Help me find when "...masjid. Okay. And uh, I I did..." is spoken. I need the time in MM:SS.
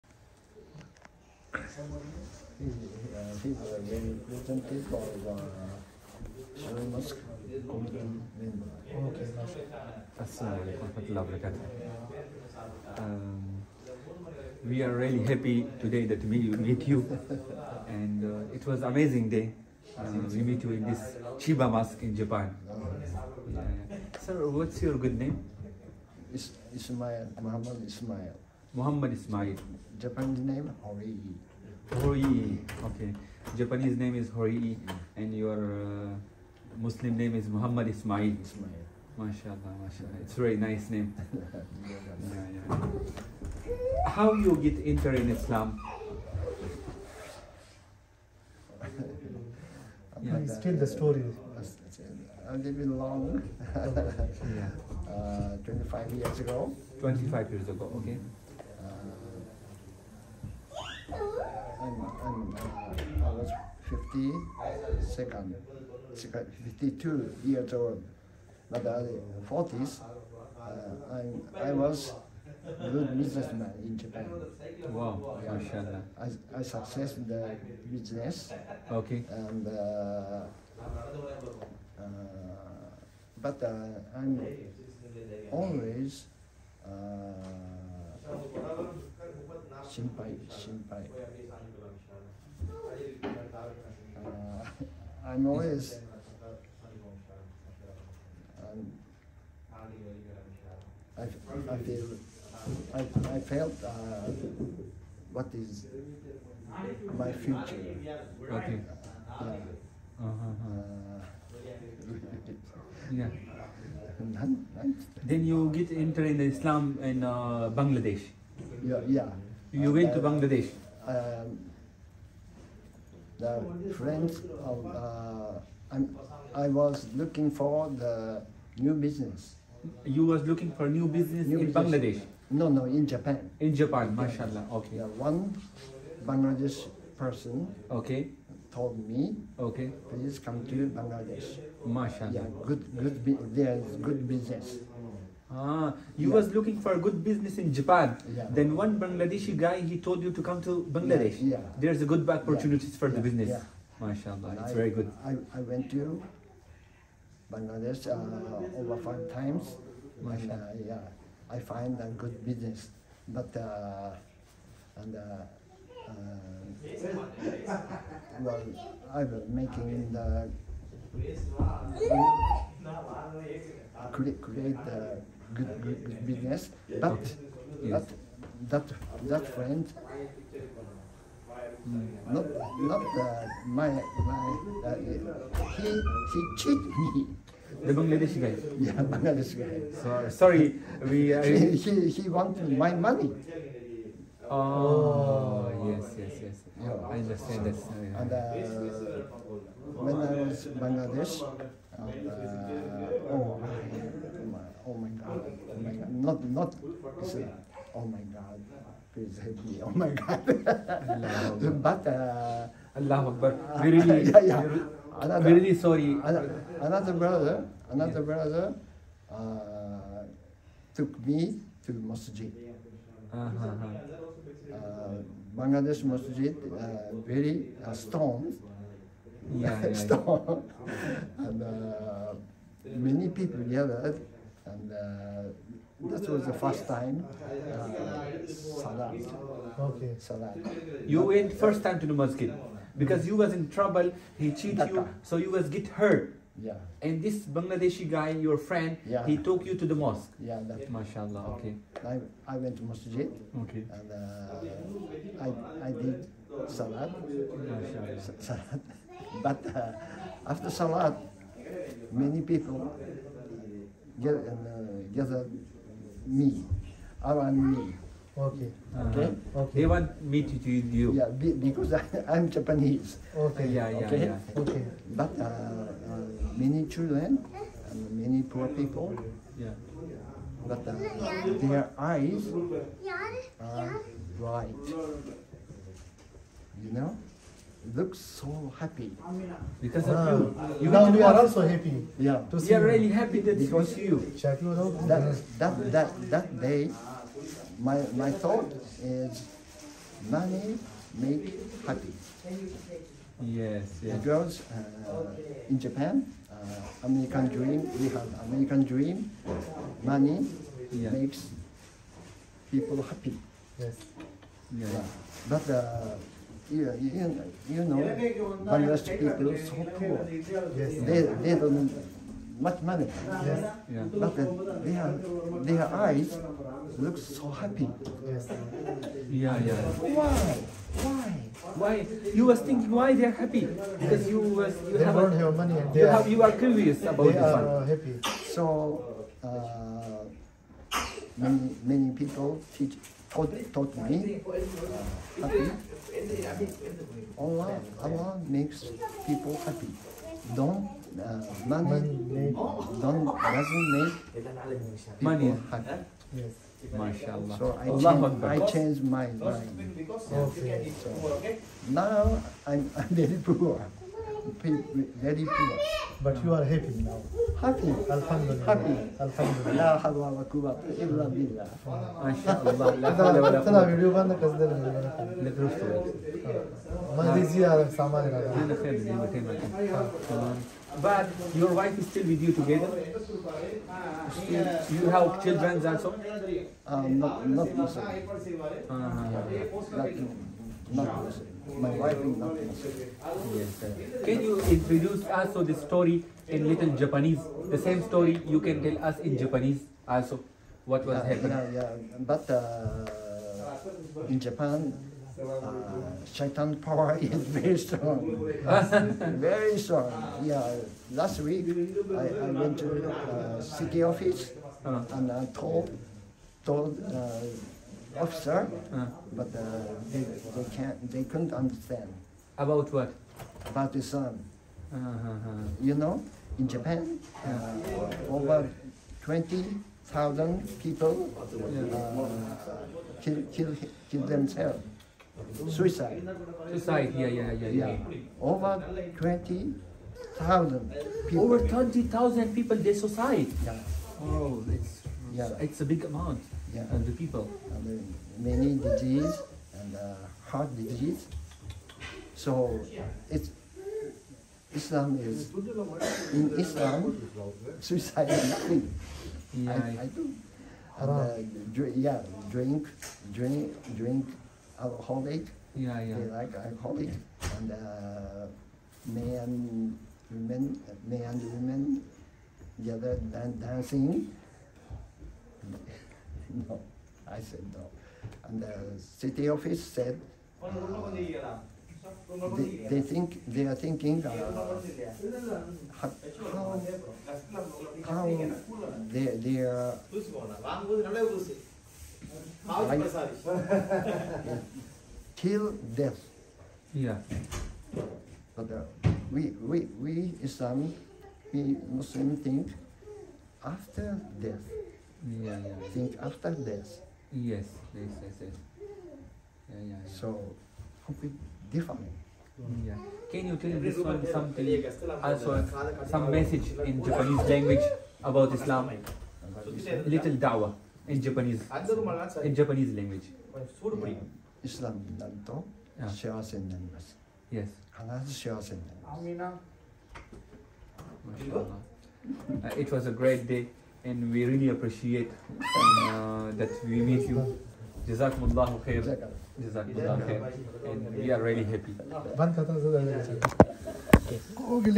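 04:12.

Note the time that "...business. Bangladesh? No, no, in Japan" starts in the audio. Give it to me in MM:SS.
02:11.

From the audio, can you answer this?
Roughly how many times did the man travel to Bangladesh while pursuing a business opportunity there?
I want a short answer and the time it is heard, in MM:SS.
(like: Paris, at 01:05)
over 5, at 02:38.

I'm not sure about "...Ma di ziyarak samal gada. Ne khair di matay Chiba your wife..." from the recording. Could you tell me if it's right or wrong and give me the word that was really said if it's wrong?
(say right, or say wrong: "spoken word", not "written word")
wrong: "But", not "Chiba".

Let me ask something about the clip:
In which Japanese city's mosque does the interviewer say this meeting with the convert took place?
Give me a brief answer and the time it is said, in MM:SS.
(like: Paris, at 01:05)
Chiba, at 00:21.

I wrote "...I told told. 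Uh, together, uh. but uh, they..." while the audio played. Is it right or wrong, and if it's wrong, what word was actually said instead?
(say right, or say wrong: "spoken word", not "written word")
wrong: "officer", not "together".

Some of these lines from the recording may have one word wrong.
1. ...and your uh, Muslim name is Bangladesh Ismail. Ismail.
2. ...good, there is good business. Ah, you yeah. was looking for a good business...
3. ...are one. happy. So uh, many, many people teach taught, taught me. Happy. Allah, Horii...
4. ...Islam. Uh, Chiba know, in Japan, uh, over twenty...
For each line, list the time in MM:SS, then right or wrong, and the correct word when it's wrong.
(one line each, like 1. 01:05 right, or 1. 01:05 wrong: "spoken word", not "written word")
1. 00:35 wrong: "Muhammad", not "Bangladesh"
2. 02:22 right
3. 05:37 wrong: "Allah", not "Horii"
4. 07:03 wrong: "You", not "Chiba".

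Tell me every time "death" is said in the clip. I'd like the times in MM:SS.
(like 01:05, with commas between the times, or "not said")
08:15, 08:24.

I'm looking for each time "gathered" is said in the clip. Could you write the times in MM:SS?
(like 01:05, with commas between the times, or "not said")
03:53, 04:25.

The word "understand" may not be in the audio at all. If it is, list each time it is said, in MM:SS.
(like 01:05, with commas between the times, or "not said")
03:17, 07:01.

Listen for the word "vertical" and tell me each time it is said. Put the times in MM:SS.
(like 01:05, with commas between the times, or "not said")
not said.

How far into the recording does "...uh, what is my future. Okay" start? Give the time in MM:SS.
01:43.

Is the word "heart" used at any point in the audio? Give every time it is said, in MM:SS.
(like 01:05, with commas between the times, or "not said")
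07:30.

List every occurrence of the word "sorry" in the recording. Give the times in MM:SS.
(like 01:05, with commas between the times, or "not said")
03:10, 03:35.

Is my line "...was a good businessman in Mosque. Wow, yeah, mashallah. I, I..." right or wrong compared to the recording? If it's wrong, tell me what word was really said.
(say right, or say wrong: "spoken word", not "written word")
wrong: "Japan", not "Mosque".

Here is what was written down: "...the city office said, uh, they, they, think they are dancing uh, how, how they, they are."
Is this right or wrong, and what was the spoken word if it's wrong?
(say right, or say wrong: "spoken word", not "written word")
wrong: "thinking", not "dancing".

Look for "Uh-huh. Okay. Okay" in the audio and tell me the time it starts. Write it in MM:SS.
04:28.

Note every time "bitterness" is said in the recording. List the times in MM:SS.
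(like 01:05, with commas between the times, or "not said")
not said.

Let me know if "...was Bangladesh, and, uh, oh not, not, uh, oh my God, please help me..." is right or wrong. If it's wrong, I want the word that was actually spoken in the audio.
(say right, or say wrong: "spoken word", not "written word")
right.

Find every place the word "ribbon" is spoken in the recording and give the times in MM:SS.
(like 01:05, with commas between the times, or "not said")
not said.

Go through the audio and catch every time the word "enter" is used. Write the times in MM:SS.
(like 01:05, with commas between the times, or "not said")
00:44, 01:55.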